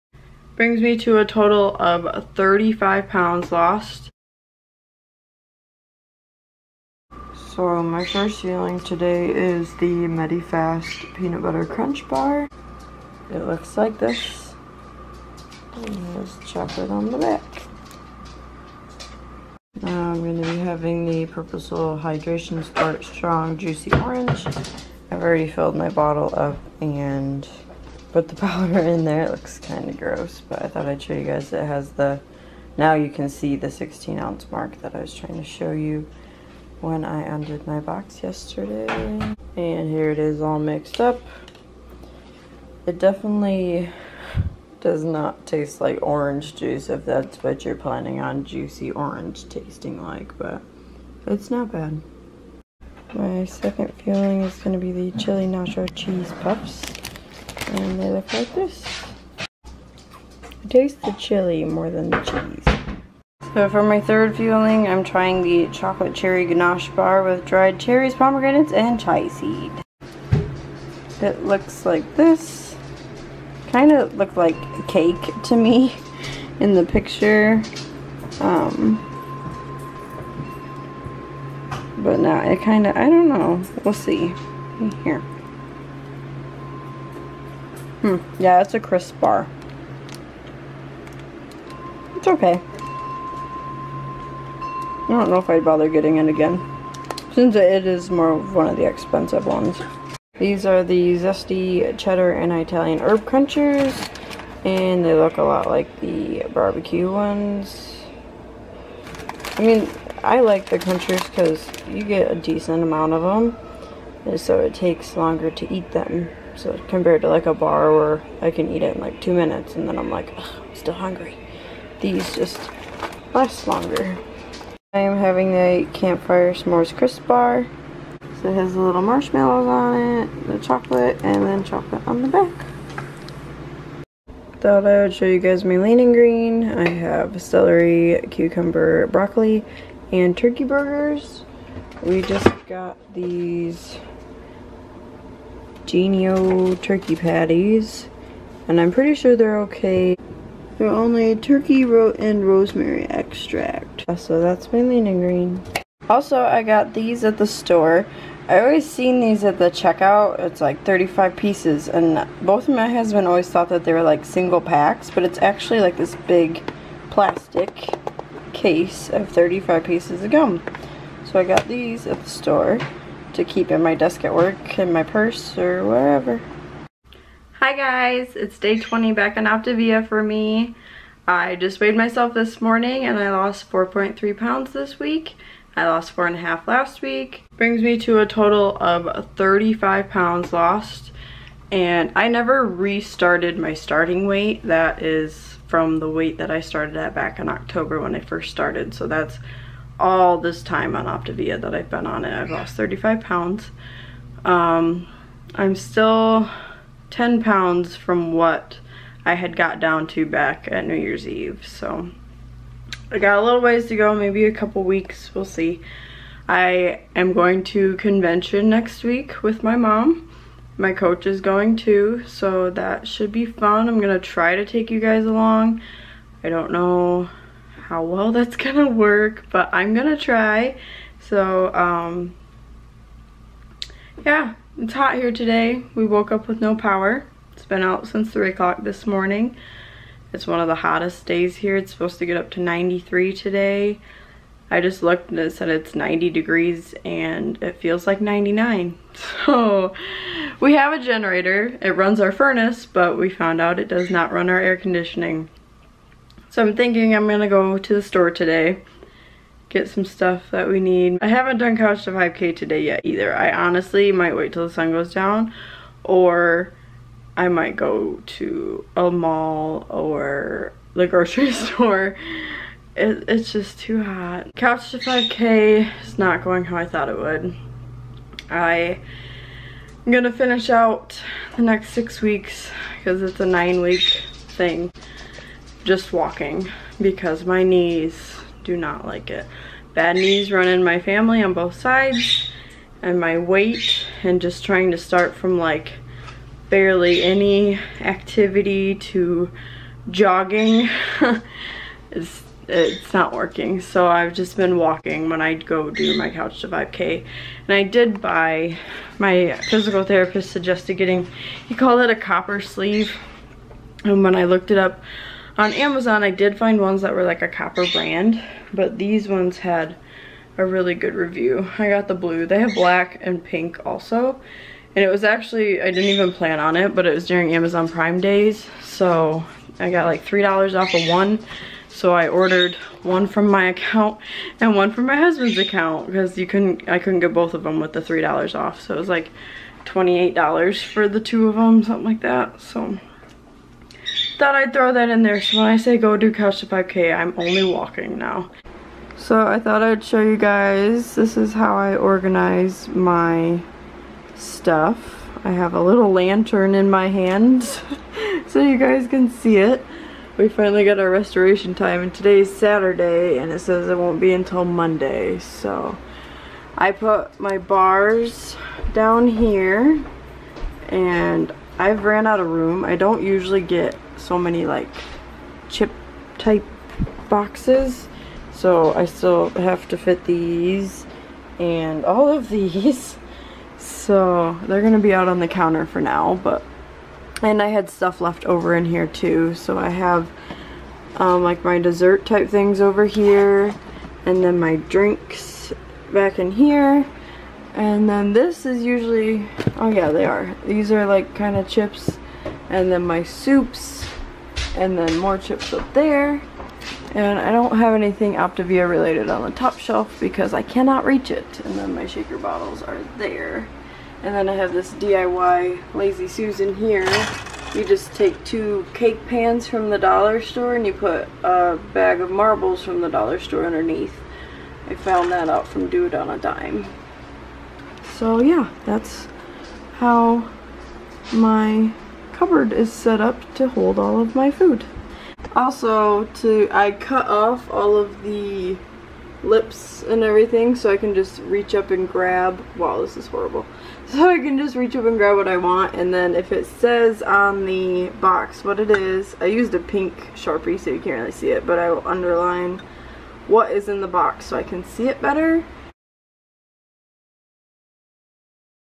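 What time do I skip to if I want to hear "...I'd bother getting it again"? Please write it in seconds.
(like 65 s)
95 s.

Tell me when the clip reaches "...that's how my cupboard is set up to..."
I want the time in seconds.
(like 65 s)
428 s.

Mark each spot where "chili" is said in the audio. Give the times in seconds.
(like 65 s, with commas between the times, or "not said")
55 s, 61 s.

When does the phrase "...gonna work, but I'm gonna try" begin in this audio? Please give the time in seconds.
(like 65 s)
228 s.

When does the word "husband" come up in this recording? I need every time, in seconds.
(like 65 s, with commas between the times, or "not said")
162 s, 335 s.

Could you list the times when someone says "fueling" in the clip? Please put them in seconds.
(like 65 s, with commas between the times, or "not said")
8 s, 54 s, 64 s.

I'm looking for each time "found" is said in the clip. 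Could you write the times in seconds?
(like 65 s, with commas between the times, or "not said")
253 s, 424 s.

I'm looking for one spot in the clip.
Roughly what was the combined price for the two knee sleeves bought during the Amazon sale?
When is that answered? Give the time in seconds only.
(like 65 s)
339 s.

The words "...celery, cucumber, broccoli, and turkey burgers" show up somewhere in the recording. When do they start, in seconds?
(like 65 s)
137 s.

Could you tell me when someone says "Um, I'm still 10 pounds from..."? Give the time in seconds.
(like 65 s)
204 s.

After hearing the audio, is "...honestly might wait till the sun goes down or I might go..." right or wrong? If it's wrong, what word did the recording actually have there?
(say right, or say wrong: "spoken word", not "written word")
right.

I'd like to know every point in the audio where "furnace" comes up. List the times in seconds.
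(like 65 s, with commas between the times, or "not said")
252 s.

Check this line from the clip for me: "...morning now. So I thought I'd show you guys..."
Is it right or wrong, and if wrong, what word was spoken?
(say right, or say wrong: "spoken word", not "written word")
wrong: "walking", not "morning".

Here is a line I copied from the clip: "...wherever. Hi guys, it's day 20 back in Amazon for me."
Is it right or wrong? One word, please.
wrong.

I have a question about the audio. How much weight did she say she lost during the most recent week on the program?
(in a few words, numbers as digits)
4.3 pounds.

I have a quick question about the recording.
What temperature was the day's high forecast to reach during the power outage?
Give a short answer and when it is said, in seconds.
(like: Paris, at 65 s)
93, at 242 s.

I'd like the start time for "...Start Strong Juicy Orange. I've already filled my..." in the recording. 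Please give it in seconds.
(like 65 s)
22 s.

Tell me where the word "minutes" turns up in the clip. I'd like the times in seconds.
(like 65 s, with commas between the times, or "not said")
119 s.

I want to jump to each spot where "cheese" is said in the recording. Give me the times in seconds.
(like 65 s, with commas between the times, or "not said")
55 s, 62 s.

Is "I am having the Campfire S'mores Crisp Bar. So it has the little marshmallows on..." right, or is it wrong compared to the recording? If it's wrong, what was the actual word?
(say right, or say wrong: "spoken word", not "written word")
right.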